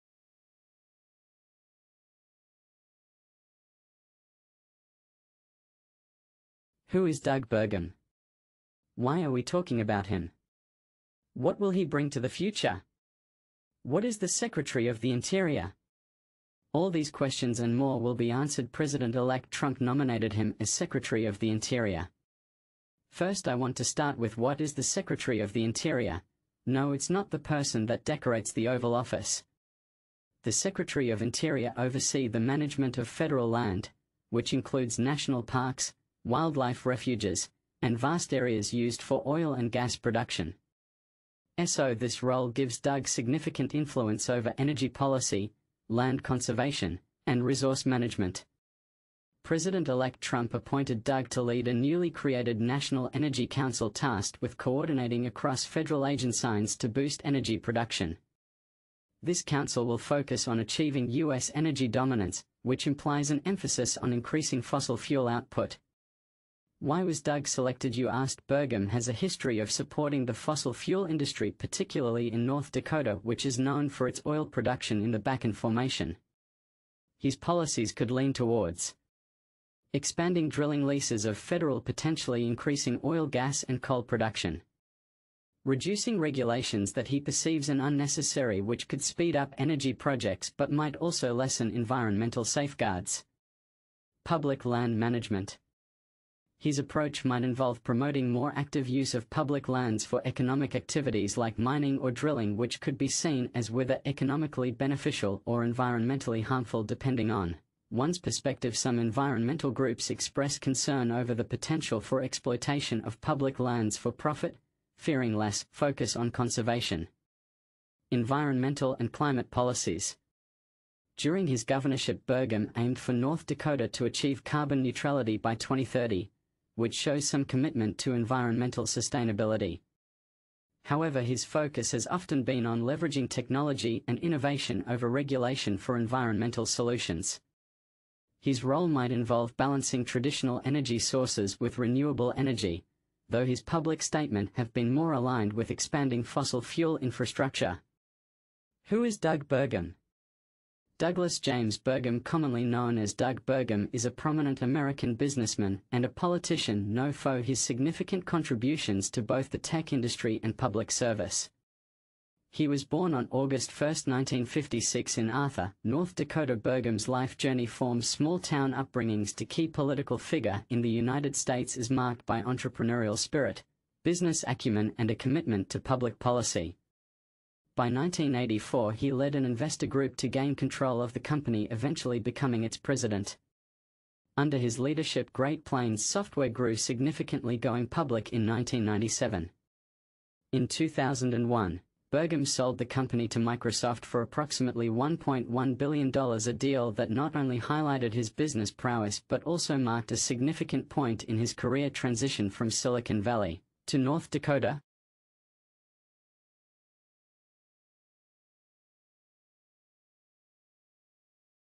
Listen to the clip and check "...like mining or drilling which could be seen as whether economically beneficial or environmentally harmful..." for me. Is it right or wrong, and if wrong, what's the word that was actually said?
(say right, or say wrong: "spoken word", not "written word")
right.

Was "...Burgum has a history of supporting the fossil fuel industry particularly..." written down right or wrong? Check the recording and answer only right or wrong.
right.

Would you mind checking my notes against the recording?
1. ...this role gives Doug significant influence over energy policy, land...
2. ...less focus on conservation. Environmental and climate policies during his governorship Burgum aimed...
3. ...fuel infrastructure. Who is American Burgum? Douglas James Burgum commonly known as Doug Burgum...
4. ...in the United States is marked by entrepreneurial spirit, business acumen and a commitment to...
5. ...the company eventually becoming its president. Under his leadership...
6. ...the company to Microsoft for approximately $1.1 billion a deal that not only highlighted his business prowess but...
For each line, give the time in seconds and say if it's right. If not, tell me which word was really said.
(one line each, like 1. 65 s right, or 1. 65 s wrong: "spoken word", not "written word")
1. 41 s right
2. 115 s right
3. 146 s wrong: "Doug", not "American"
4. 170 s right
5. 181 s right
6. 192 s right.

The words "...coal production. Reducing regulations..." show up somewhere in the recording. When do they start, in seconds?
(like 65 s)
83 s.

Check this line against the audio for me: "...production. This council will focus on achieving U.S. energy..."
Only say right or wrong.
right.